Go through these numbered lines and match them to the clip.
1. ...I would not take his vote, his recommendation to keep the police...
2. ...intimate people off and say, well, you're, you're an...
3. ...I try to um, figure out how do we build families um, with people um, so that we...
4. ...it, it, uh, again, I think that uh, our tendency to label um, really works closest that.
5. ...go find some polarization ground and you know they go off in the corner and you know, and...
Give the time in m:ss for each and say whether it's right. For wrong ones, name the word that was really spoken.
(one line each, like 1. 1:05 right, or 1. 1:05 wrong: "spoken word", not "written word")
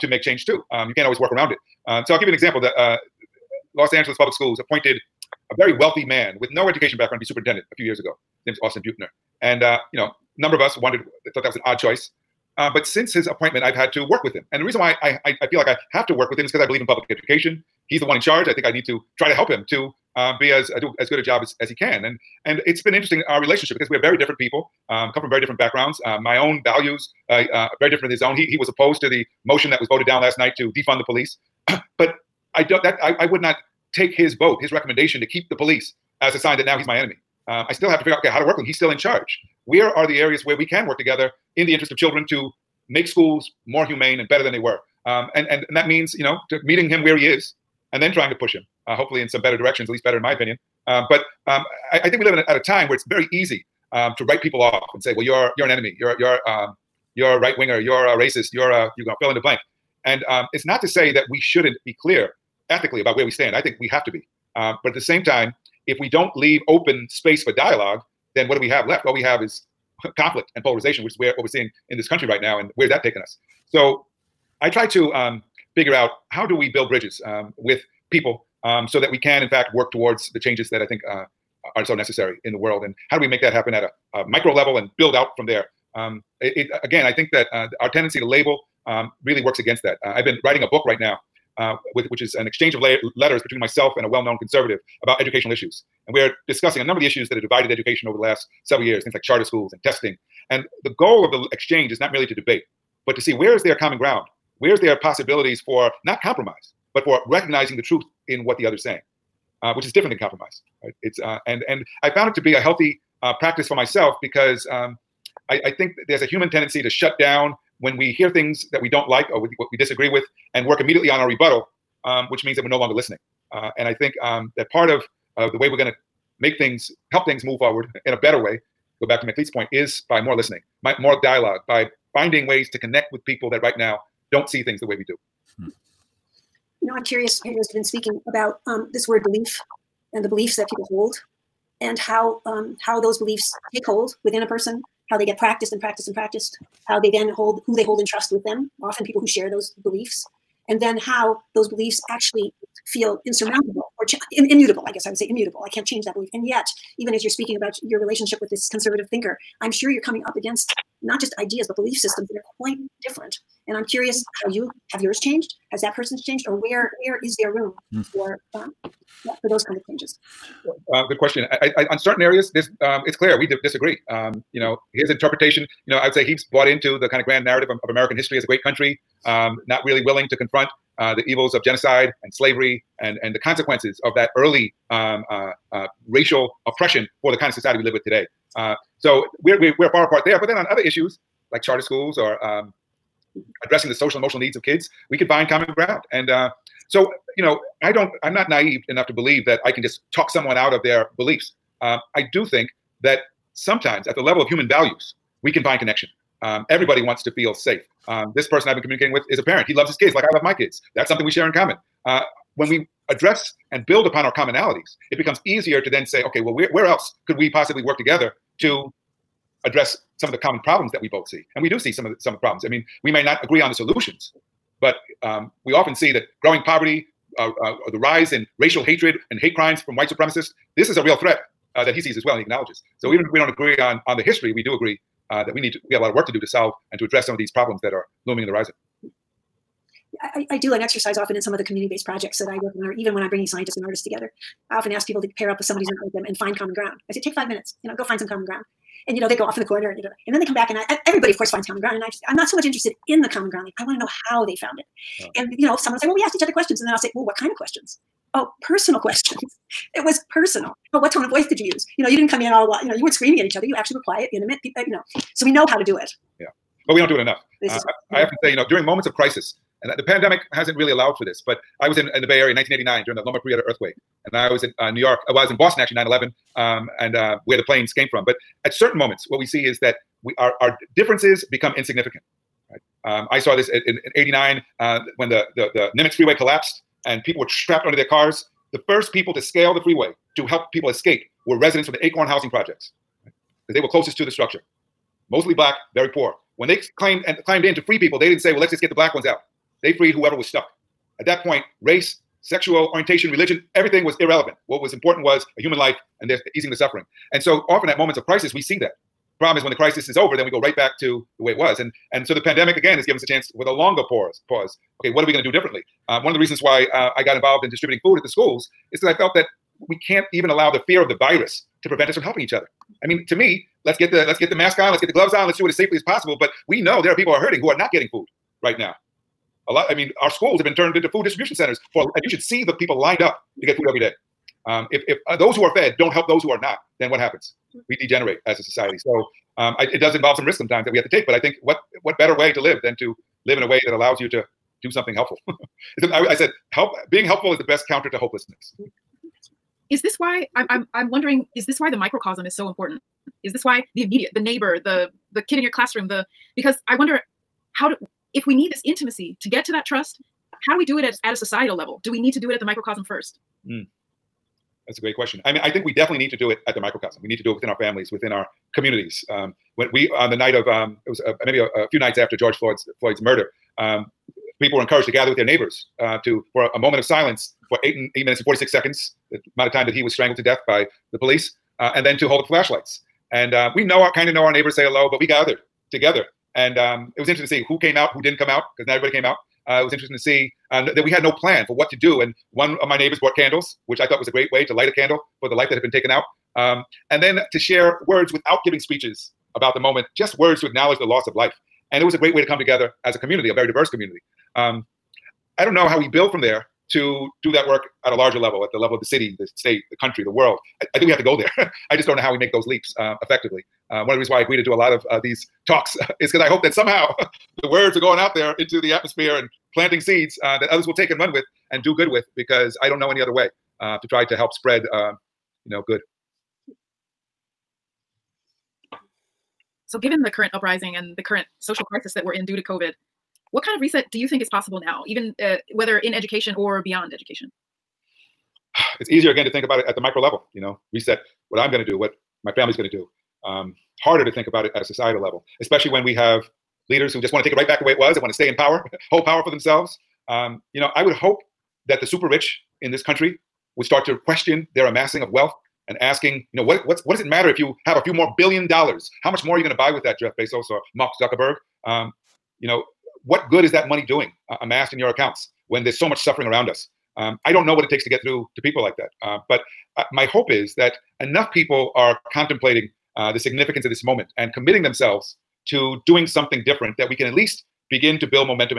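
1. 0:33 right
2. 0:54 wrong: "write", not "intimate"
3. 1:14 wrong: "bridges", not "families"
4. 1:26 wrong: "against", not "closest"
5. 4:07 wrong: "common", not "polarization".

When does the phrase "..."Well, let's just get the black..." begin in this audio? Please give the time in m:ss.
4:58.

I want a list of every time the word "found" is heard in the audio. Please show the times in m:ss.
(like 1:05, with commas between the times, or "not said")
1:52, 4:14.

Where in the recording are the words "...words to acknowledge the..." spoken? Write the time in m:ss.
6:40.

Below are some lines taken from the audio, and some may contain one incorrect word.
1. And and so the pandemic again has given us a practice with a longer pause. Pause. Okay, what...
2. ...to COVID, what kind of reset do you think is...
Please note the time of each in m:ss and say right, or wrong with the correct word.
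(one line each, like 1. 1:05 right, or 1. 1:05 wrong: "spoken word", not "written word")
1. 5:11 wrong: "chance", not "practice"
2. 7:12 right.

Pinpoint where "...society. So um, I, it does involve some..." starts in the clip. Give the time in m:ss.
5:38.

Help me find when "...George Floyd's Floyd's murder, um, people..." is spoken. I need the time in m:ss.
6:12.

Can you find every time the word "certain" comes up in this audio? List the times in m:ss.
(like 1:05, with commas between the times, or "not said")
2:51, 4:38.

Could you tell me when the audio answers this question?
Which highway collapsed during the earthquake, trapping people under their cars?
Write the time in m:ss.
4:45.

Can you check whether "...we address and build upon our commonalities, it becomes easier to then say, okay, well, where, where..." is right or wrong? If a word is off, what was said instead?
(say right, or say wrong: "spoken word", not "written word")
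right.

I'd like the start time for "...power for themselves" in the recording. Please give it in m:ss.
7:29.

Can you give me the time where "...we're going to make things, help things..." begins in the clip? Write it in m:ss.
2:05.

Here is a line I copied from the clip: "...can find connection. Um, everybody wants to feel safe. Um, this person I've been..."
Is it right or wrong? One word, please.
right.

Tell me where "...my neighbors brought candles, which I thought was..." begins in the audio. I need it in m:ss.
6:32.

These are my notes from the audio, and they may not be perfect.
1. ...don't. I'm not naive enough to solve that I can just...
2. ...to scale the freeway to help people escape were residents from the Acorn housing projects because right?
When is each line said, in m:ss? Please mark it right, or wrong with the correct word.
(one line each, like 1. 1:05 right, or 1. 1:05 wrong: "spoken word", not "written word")
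1. 3:17 wrong: "believe", not "solve"
2. 4:49 right.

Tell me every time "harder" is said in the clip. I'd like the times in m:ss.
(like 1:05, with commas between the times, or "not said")
7:24.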